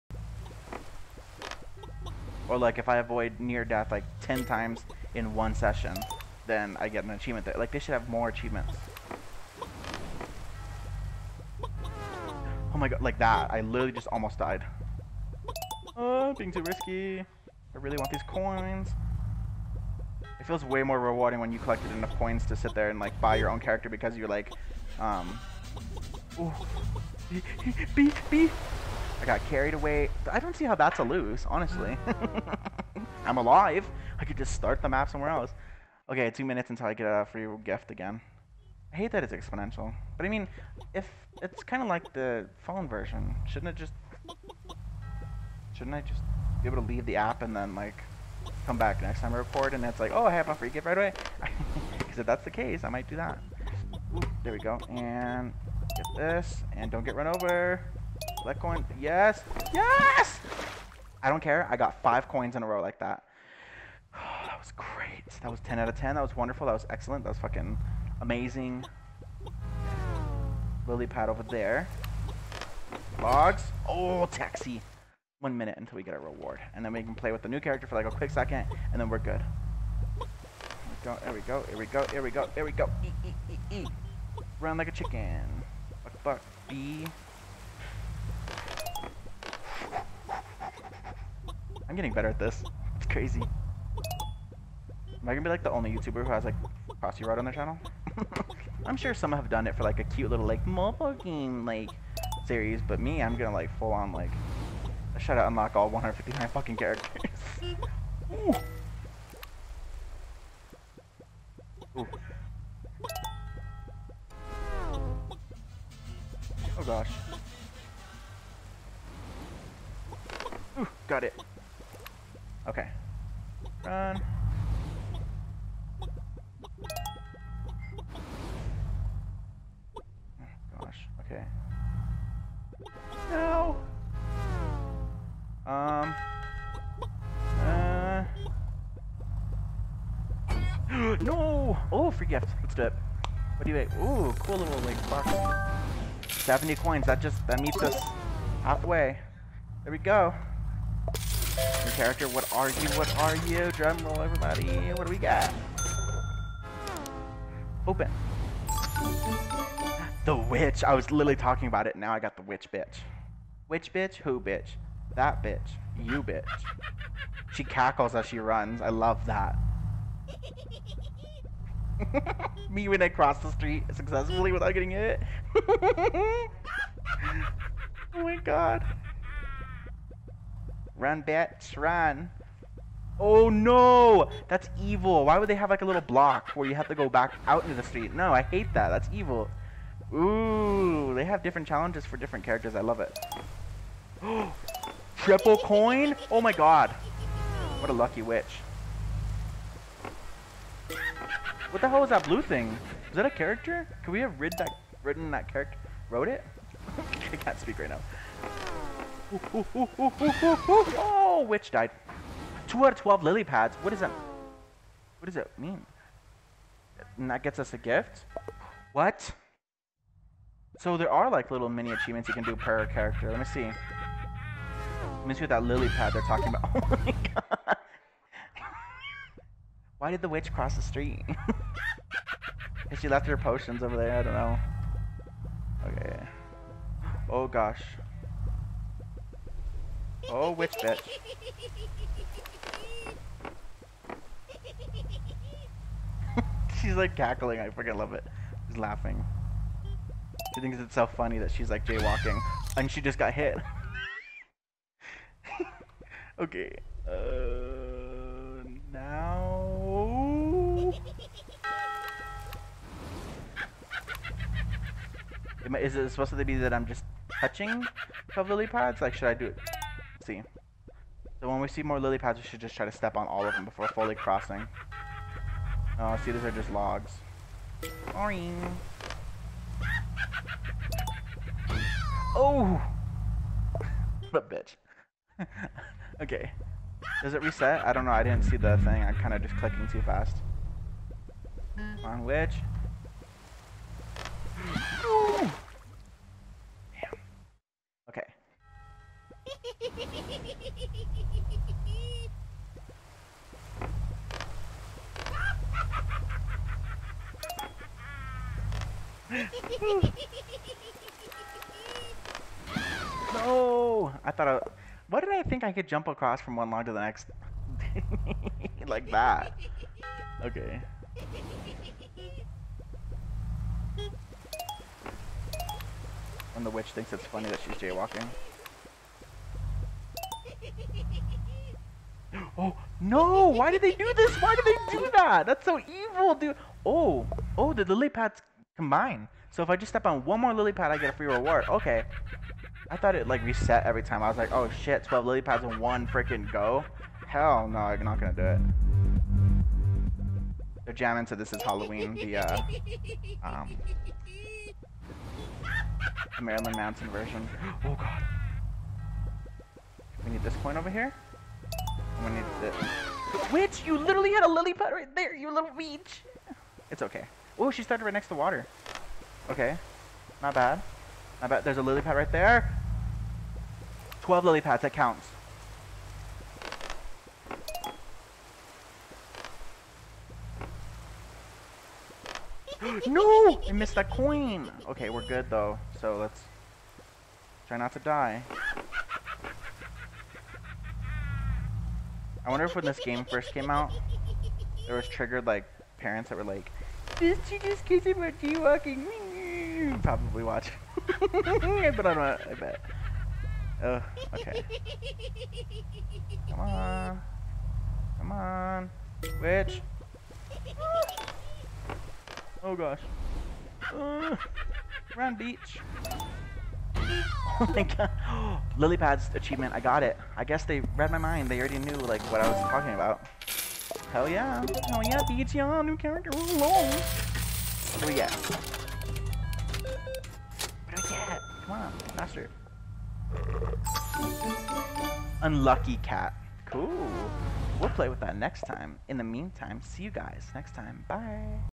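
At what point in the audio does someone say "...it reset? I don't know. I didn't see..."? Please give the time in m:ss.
4:47.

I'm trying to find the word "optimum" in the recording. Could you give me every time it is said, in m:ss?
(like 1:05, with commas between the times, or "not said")
not said.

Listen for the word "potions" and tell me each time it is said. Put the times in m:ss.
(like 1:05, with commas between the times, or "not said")
3:53.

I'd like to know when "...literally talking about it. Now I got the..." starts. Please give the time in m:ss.
2:41.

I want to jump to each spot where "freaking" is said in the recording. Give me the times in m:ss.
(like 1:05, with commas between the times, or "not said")
4:07, 5:46.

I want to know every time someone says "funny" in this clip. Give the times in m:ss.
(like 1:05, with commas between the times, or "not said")
4:11, 5:27.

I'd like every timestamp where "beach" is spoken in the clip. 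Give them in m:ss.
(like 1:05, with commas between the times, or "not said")
6:05, 6:55.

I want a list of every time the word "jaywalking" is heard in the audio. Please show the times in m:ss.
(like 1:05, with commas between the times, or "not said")
4:11, 5:27.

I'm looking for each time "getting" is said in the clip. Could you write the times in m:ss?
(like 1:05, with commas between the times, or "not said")
1:31, 2:54.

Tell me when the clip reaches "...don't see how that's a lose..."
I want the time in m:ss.
0:30.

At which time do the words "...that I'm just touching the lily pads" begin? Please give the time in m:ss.
4:26.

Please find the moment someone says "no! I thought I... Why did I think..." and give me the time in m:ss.
5:13.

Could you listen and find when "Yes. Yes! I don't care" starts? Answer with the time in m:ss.
0:58.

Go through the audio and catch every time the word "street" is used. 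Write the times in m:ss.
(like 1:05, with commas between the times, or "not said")
2:53, 3:07, 3:50.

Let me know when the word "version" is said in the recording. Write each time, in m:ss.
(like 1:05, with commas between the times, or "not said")
0:42, 5:57.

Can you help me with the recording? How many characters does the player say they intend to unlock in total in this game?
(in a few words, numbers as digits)
159.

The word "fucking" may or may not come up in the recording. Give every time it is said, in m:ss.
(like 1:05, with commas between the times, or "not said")
1:07, 1:46.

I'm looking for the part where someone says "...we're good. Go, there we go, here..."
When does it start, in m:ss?
1:19.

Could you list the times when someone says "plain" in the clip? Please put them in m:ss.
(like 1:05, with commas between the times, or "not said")
not said.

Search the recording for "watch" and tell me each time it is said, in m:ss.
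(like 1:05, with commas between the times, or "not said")
6:40.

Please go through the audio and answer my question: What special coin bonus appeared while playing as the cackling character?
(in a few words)
Triple coin.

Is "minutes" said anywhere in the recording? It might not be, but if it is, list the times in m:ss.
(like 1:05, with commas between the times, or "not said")
0:36, 1:15.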